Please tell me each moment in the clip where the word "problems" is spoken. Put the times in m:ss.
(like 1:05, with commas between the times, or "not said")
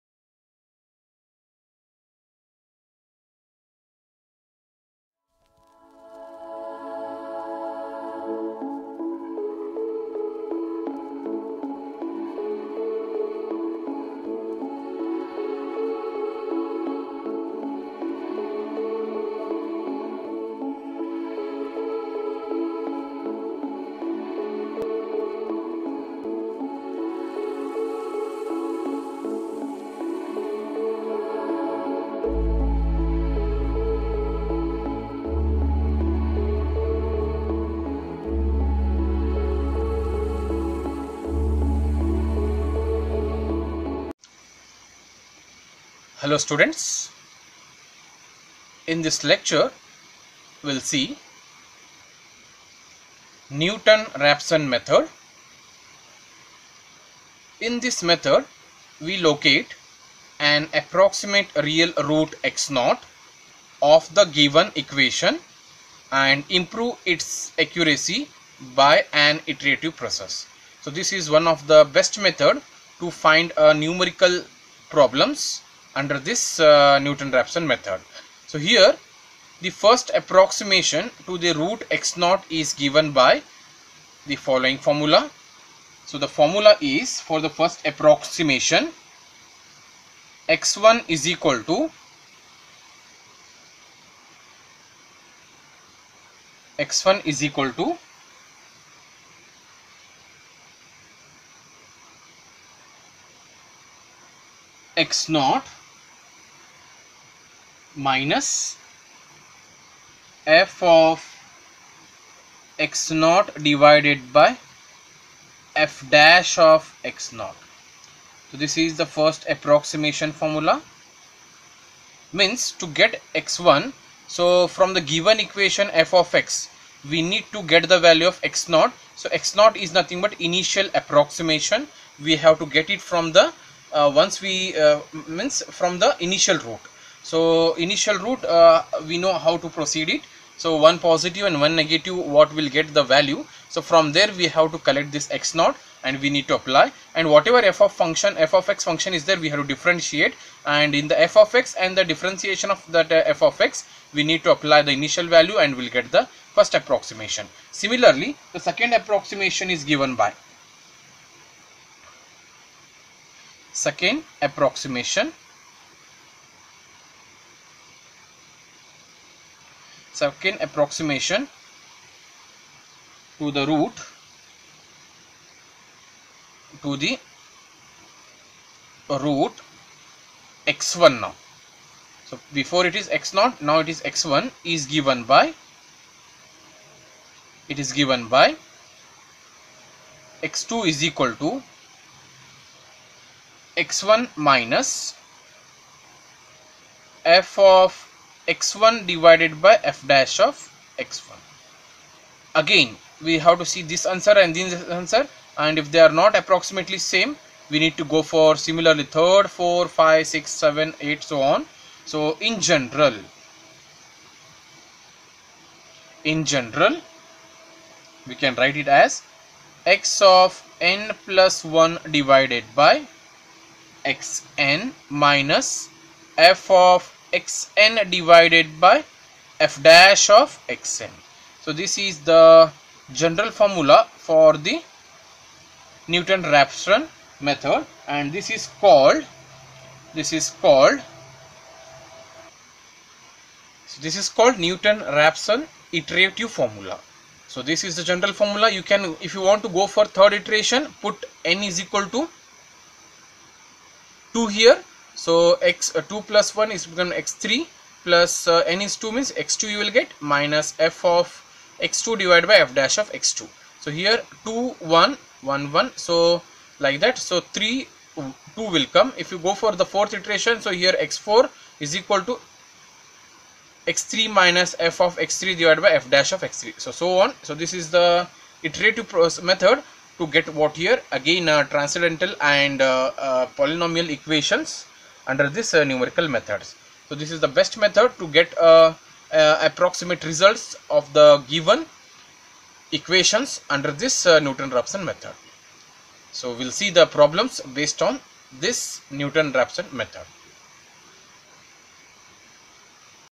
1:14, 4:57.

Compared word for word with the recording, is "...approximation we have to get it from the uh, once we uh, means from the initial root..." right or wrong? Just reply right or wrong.
right.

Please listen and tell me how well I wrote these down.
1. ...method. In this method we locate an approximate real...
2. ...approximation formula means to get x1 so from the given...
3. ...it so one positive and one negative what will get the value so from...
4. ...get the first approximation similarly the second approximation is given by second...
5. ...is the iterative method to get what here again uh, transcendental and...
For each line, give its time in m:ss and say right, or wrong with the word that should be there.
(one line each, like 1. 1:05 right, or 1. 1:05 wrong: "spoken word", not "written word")
1. 0:54 right
2. 1:59 right
3. 2:20 right
4. 2:35 right
5. 4:37 right.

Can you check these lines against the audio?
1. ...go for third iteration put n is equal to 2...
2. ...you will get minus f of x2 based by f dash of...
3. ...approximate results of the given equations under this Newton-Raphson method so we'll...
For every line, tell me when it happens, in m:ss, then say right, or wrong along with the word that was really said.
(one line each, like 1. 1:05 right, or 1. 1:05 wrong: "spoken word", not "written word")
1. 4:09 right
2. 4:19 wrong: "divided", not "based"
3. 4:49 right.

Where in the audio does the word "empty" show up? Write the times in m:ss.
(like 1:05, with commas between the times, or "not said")
not said.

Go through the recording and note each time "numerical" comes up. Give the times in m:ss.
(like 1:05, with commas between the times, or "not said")
1:13, 4:45.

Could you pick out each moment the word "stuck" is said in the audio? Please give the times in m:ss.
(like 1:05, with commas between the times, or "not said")
not said.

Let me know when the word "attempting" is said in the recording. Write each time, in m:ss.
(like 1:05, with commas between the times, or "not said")
not said.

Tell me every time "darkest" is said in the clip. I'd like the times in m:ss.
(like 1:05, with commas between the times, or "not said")
not said.